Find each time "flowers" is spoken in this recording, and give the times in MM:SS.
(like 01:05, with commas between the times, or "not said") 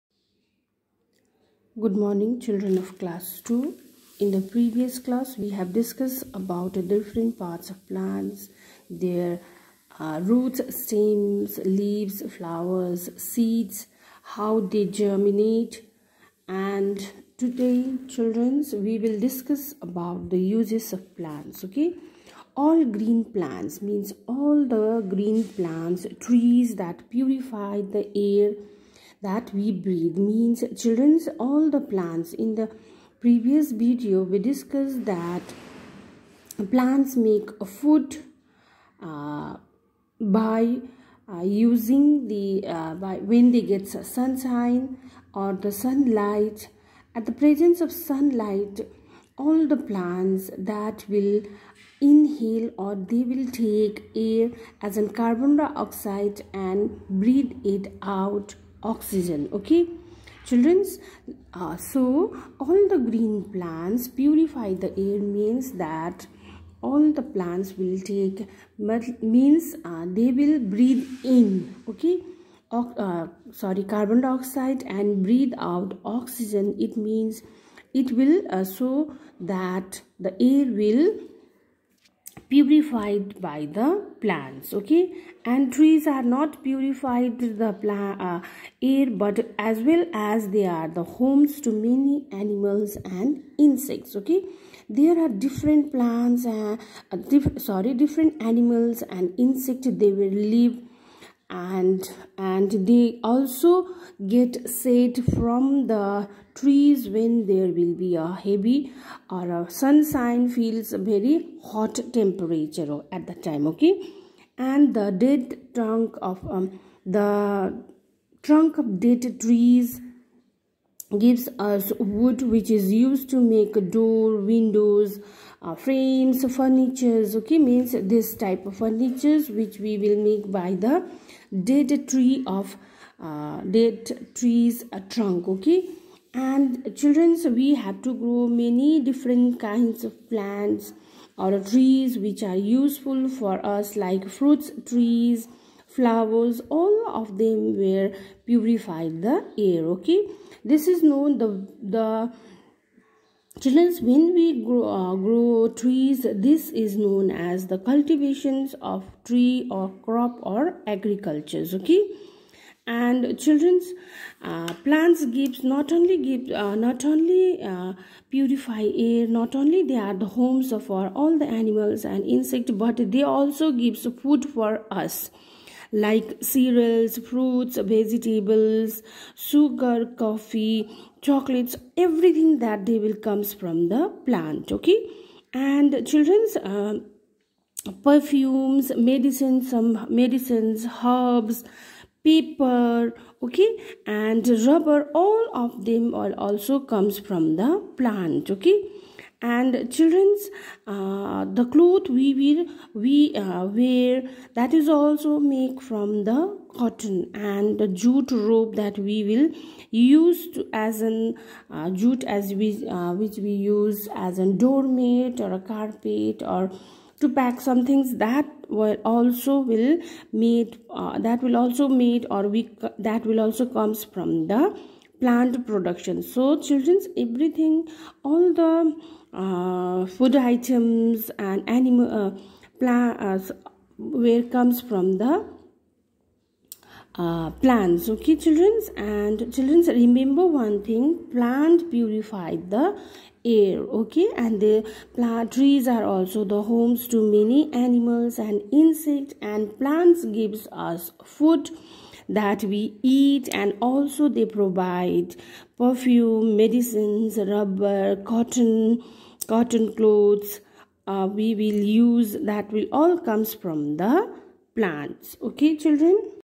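00:12, 02:25.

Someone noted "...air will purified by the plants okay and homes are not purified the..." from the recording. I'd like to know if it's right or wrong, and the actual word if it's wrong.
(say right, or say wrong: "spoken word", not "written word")
wrong: "trees", not "homes".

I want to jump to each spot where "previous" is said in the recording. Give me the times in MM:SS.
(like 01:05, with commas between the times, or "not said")
00:04, 00:33.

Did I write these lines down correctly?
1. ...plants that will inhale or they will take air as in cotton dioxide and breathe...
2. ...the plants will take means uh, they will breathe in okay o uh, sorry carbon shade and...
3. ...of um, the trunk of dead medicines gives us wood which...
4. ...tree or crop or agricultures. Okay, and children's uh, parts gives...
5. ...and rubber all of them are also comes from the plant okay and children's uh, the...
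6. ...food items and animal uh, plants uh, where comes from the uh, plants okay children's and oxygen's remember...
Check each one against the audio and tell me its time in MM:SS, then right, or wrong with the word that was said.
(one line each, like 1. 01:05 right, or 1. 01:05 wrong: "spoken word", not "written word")
1. 00:49 wrong: "carbon", not "cotton"
2. 01:07 wrong: "dioxide", not "shade"
3. 01:56 wrong: "trees", not "medicines"
4. 02:39 wrong: "plants", not "parts"
5. 03:14 right
6. 03:50 wrong: "children", not "oxygen".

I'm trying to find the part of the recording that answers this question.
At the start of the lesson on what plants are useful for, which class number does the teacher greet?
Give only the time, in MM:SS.
00:02.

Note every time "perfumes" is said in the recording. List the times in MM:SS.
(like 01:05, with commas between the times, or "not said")
03:08, 04:15.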